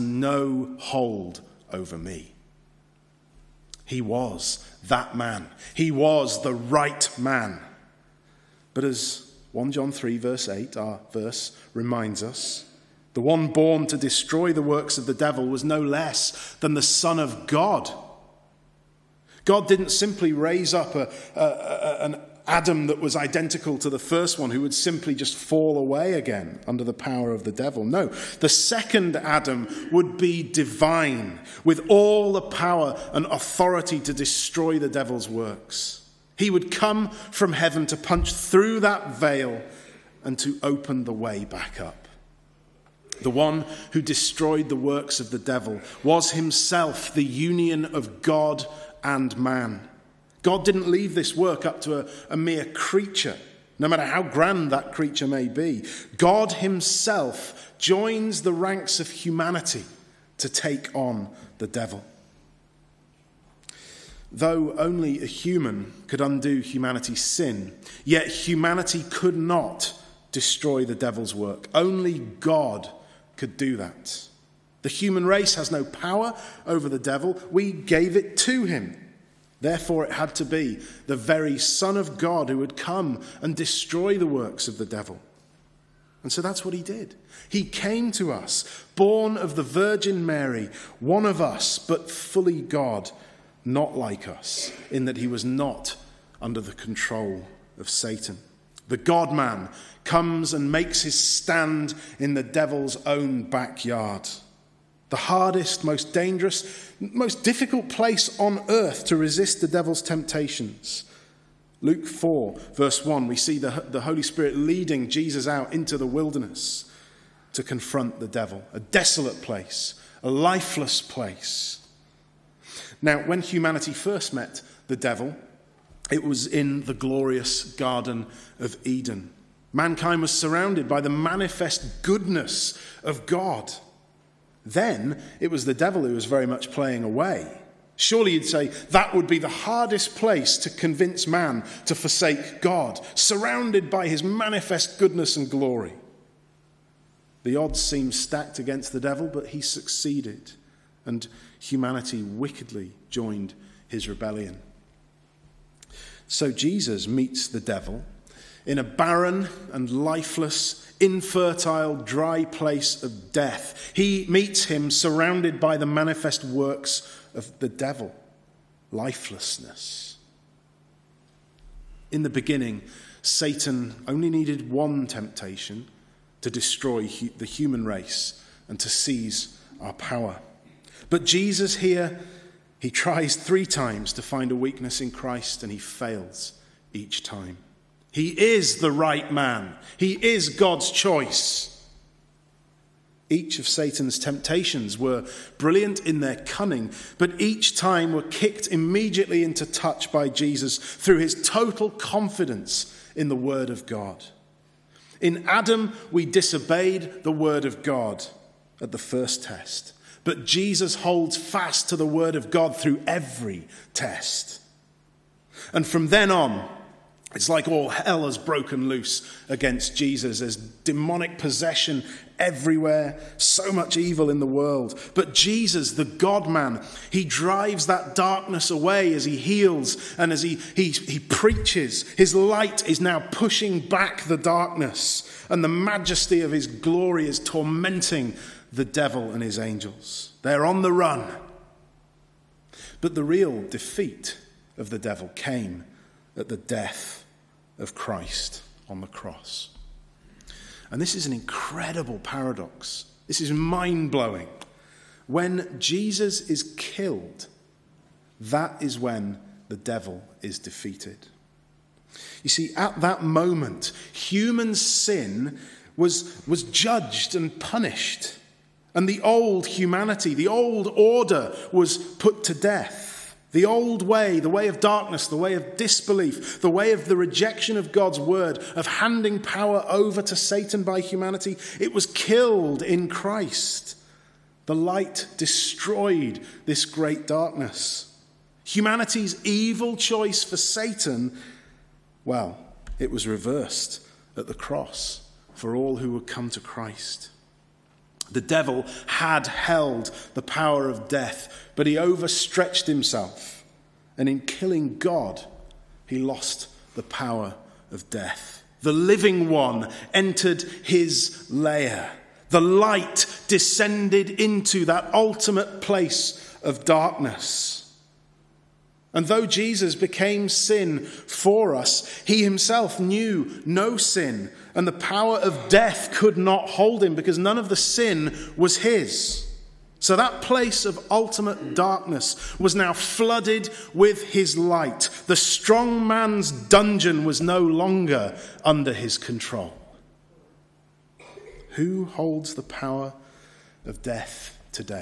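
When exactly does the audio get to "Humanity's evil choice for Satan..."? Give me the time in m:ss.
4:48.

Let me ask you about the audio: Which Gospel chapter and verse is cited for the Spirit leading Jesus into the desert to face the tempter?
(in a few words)
Luke 4:1.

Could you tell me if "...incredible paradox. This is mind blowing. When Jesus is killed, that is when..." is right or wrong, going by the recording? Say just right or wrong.
right.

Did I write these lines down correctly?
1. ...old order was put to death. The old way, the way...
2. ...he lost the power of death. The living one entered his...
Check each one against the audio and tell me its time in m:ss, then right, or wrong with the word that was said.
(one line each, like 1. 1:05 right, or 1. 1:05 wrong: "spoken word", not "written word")
1. 4:30 right
2. 5:06 right.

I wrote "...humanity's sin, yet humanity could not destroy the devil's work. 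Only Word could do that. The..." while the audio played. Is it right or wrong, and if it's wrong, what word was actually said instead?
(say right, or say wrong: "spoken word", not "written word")
wrong: "God", not "Word".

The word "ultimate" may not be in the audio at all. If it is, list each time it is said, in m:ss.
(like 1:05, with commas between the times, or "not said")
5:15, 5:31.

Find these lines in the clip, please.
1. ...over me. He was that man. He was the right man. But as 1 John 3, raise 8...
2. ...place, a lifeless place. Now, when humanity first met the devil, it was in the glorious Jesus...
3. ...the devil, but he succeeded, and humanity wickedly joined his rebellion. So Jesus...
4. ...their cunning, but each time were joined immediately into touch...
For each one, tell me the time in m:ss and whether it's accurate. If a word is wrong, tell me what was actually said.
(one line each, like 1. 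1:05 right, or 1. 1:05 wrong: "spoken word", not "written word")
1. 0:01 wrong: "verse", not "raise"
2. 1:59 wrong: "Garden", not "Jesus"
3. 2:28 right
4. 3:16 wrong: "kicked", not "joined".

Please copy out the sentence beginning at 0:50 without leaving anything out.
God didn't leave this work up to a, a mere creature, no matter how grand that creature may be.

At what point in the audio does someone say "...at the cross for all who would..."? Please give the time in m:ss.
4:54.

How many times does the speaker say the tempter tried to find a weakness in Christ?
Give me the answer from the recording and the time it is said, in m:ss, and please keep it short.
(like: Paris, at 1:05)
3, at 3:03.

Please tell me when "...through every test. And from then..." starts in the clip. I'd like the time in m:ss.
3:32.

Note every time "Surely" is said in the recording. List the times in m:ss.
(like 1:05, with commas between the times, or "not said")
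2:17.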